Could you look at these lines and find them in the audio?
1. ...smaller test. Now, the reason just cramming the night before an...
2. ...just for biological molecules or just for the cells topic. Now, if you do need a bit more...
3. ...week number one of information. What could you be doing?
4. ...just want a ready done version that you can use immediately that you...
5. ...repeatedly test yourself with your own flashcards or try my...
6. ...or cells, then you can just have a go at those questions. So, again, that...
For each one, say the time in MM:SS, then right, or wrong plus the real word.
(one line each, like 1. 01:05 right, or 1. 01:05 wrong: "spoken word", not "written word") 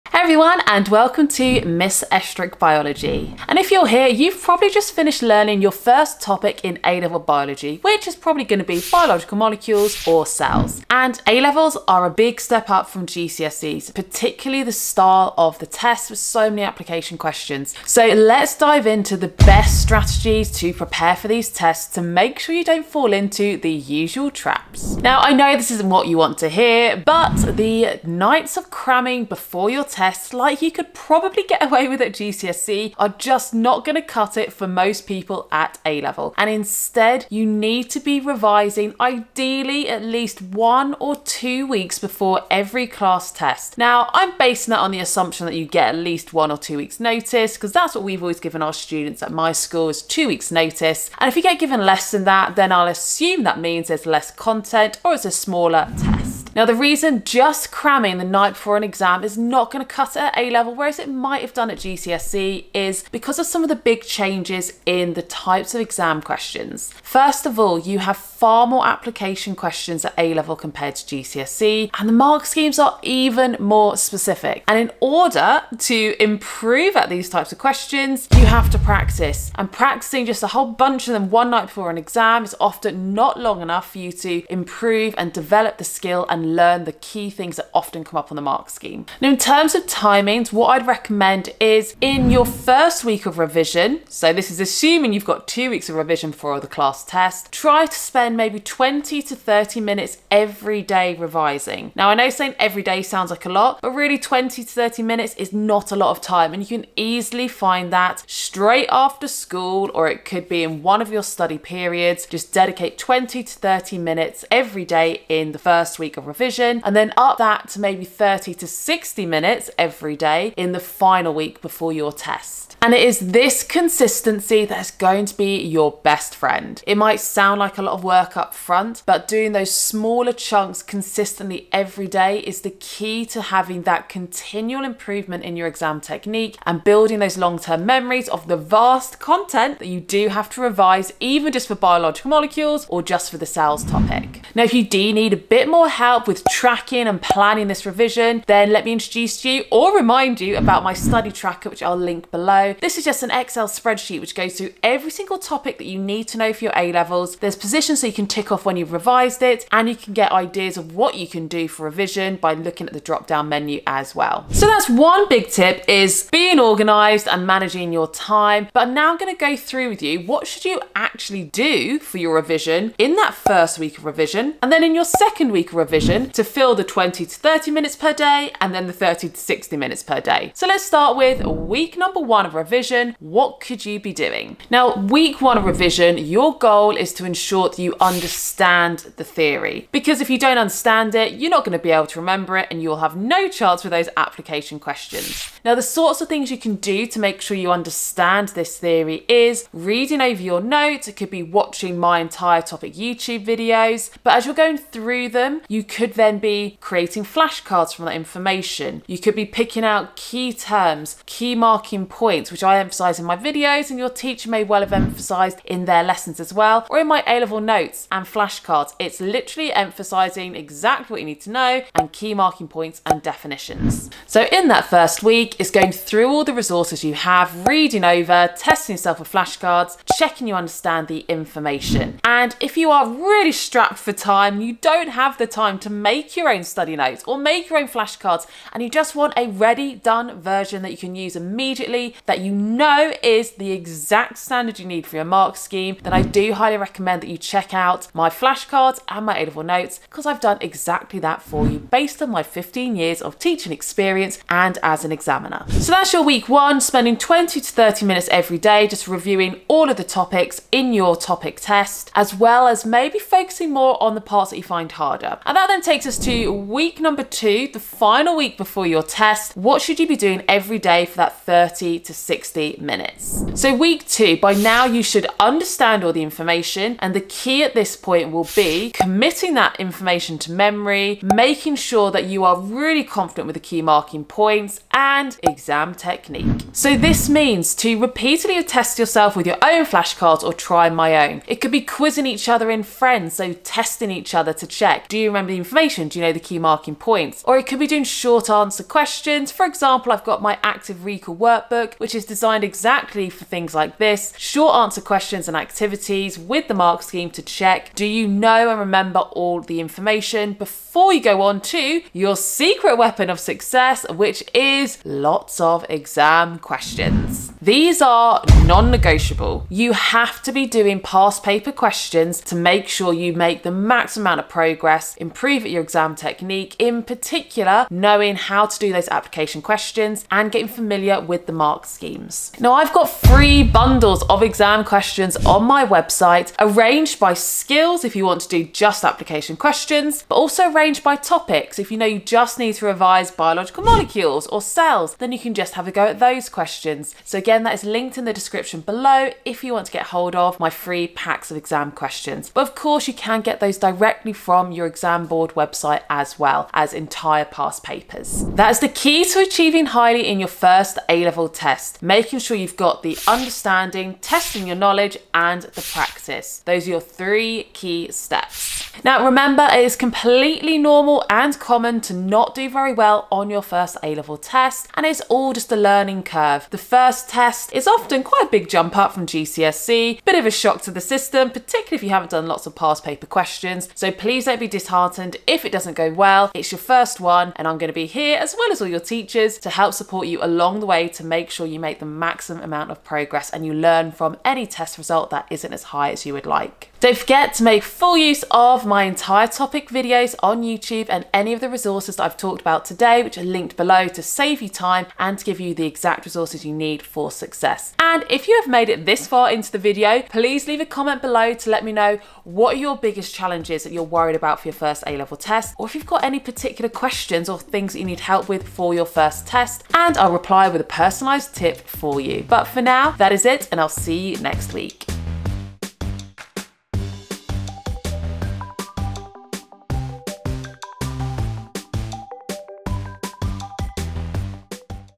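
1. 00:55 right
2. 02:21 right
3. 03:01 wrong: "revision", not "information"
4. 03:58 right
5. 04:47 right
6. 05:44 right.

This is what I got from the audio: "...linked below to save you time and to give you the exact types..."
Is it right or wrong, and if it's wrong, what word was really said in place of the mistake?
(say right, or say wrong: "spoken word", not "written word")
wrong: "resources", not "types".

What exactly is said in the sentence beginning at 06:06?
Those are your three key steps.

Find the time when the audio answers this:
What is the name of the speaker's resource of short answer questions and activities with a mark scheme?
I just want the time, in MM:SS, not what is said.
05:00.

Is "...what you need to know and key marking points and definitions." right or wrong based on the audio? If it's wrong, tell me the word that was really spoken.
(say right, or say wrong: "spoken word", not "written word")
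right.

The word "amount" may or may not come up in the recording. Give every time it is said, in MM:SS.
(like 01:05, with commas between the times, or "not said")
05:24, 06:32.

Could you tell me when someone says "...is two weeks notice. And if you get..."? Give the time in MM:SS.
00:49.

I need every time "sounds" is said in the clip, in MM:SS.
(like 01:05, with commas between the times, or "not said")
01:43, 02:07.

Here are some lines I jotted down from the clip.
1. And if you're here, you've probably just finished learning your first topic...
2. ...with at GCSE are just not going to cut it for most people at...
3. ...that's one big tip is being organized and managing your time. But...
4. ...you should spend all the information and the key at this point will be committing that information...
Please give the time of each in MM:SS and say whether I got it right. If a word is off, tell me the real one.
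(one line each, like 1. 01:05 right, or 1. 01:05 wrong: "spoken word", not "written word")
1. 00:03 right
2. 00:31 right
3. 02:44 right
4. 04:34 wrong: "understand", not "spend".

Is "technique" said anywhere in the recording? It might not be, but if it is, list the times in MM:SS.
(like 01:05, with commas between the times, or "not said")
02:16, 04:45, 05:26.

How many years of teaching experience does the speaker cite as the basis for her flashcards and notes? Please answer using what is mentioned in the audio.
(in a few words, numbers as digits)
15 years.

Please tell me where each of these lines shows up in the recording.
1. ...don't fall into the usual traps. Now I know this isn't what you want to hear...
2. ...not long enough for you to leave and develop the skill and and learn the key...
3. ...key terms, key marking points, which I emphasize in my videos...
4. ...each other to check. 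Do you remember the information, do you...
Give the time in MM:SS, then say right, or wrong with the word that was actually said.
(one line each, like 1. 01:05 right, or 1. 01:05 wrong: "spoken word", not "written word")
1. 00:22 right
2. 01:23 wrong: "improve", not "leave"
3. 03:30 right
4. 04:54 right.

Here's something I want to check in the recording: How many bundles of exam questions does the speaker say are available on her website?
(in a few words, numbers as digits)
3.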